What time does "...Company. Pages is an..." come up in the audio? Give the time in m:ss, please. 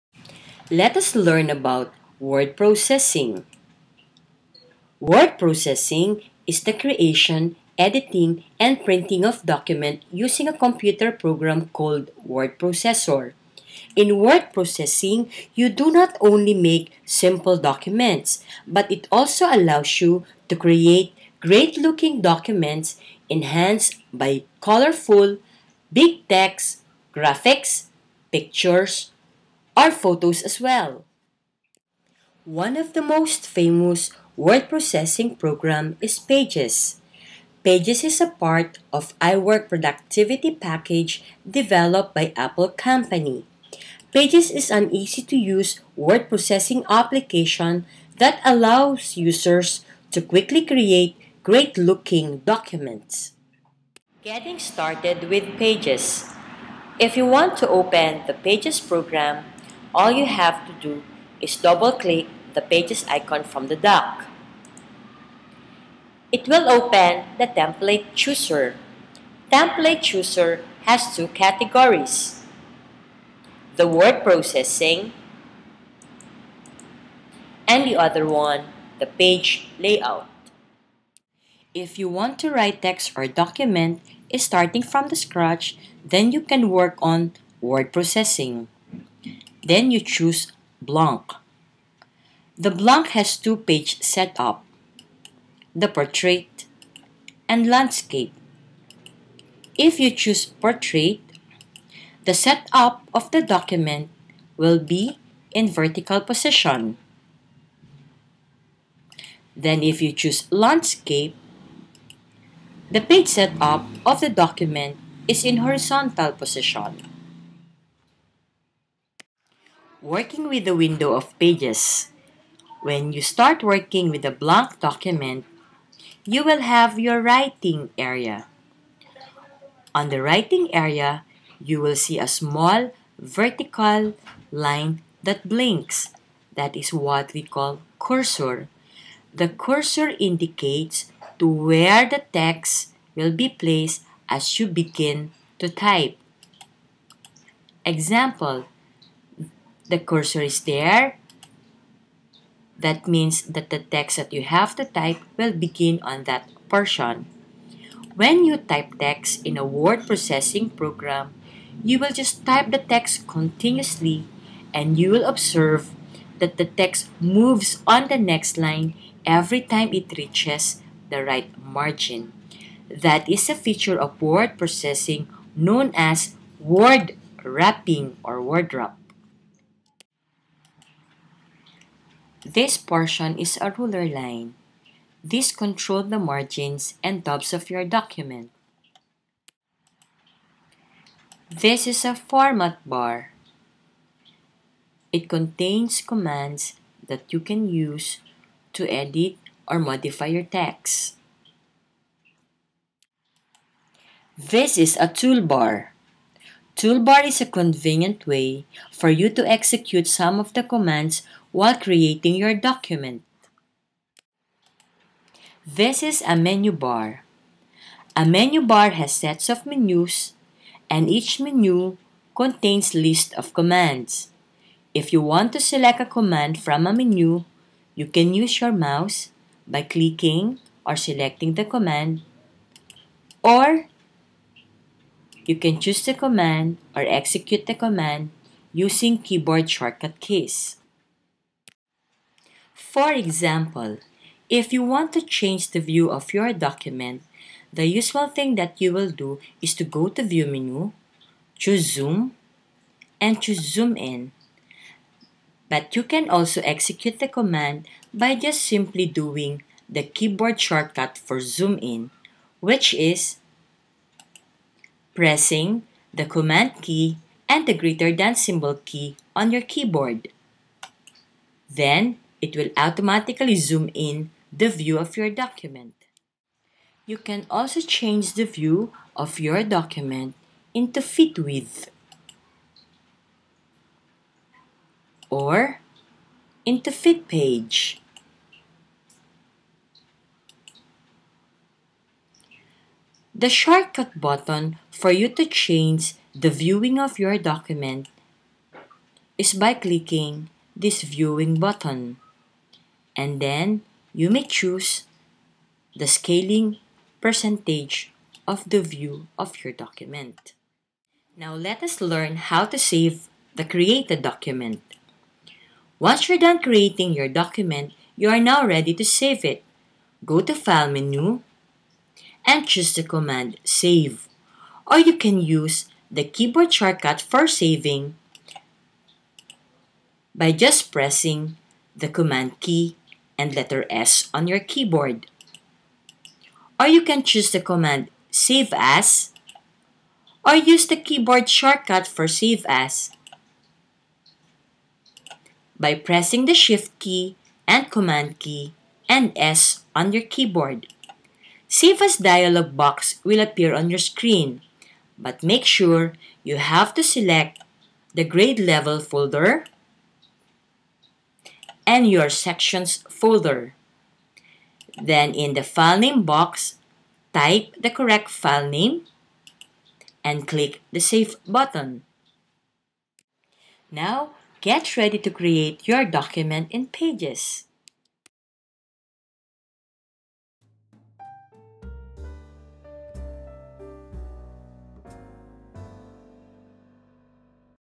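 0:42.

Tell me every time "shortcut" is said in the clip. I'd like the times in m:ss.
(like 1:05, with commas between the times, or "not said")
3:59, 4:20, 4:53, 5:26, 5:41.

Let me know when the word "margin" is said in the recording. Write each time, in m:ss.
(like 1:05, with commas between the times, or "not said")
2:51, 3:06.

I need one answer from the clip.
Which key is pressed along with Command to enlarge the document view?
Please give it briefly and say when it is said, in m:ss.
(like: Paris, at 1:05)
Greater than symbol, at 4:27.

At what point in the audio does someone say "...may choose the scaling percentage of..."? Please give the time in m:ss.
5:04.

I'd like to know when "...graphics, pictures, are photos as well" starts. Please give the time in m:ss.
0:27.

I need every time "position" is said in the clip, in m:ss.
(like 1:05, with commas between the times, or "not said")
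1:46, 1:56.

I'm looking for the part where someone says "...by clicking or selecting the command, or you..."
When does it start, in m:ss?
3:49.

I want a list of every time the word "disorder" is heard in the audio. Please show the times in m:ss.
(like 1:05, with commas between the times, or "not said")
not said.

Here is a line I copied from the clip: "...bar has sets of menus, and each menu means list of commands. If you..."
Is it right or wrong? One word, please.
wrong.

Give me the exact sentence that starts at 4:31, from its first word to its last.
Then, it will automatically zoom in the view of your document.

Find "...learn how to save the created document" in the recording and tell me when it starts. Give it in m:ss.
5:12.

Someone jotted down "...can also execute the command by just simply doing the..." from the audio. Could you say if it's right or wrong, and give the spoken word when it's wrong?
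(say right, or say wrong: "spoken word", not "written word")
right.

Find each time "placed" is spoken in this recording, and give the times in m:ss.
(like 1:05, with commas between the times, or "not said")
2:23.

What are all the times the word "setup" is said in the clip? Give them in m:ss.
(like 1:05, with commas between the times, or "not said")
1:34, 1:42, 1:53.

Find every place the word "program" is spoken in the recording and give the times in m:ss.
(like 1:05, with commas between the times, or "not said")
0:11, 0:35, 0:58, 2:40.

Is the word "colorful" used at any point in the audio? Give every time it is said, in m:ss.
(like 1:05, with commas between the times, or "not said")
0:24.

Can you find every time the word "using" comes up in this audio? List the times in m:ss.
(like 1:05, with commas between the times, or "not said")
0:10, 3:58.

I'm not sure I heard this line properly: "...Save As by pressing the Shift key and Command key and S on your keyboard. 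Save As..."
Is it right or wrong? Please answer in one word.
right.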